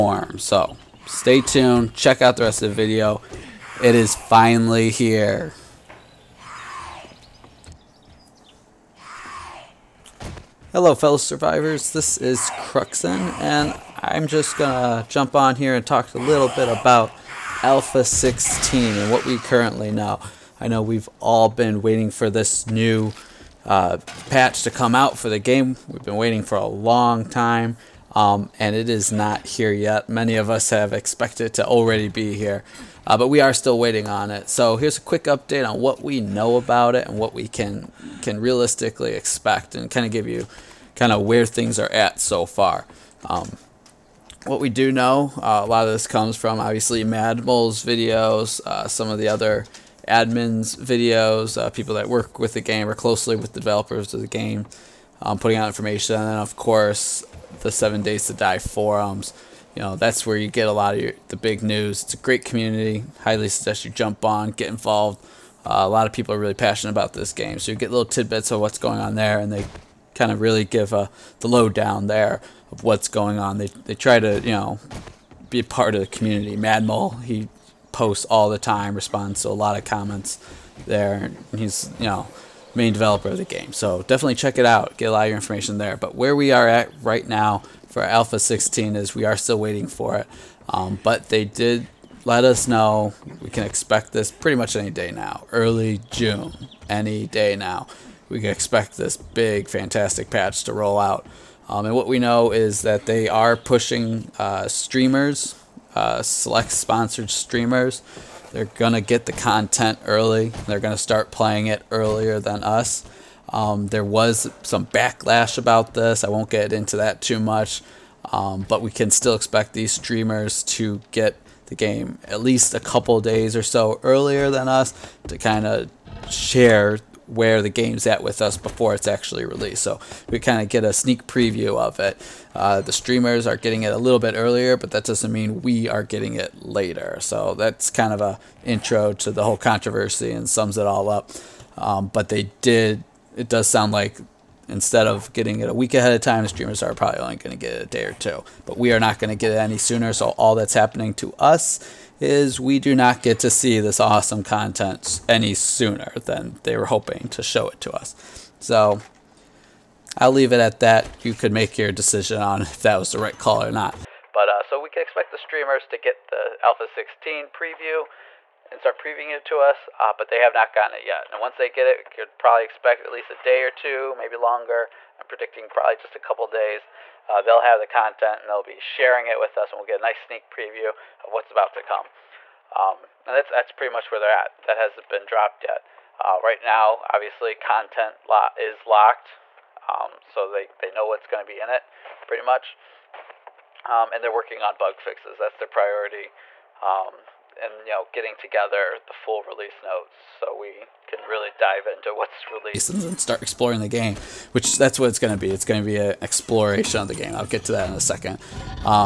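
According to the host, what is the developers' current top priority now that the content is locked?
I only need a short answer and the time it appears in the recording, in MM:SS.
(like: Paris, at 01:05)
Bug fixes, at 03:14.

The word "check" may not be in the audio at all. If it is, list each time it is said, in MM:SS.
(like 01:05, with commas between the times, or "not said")
00:01, 01:24.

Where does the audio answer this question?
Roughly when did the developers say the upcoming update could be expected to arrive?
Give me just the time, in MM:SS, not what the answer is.
01:35.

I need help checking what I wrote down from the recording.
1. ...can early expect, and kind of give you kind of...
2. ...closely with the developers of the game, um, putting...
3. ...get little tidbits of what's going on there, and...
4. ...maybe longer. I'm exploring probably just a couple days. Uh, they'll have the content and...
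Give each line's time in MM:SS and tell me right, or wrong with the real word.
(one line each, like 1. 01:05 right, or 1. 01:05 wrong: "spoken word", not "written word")
1. 00:38 wrong: "realistically", not "early"
2. 00:52 right
3. 01:07 right
4. 02:54 wrong: "predicting", not "exploring".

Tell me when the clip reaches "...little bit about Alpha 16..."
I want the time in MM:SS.
00:16.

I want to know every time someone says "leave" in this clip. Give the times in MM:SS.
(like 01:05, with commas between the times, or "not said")
02:40.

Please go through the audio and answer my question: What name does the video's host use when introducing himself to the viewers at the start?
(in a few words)
Kruxn.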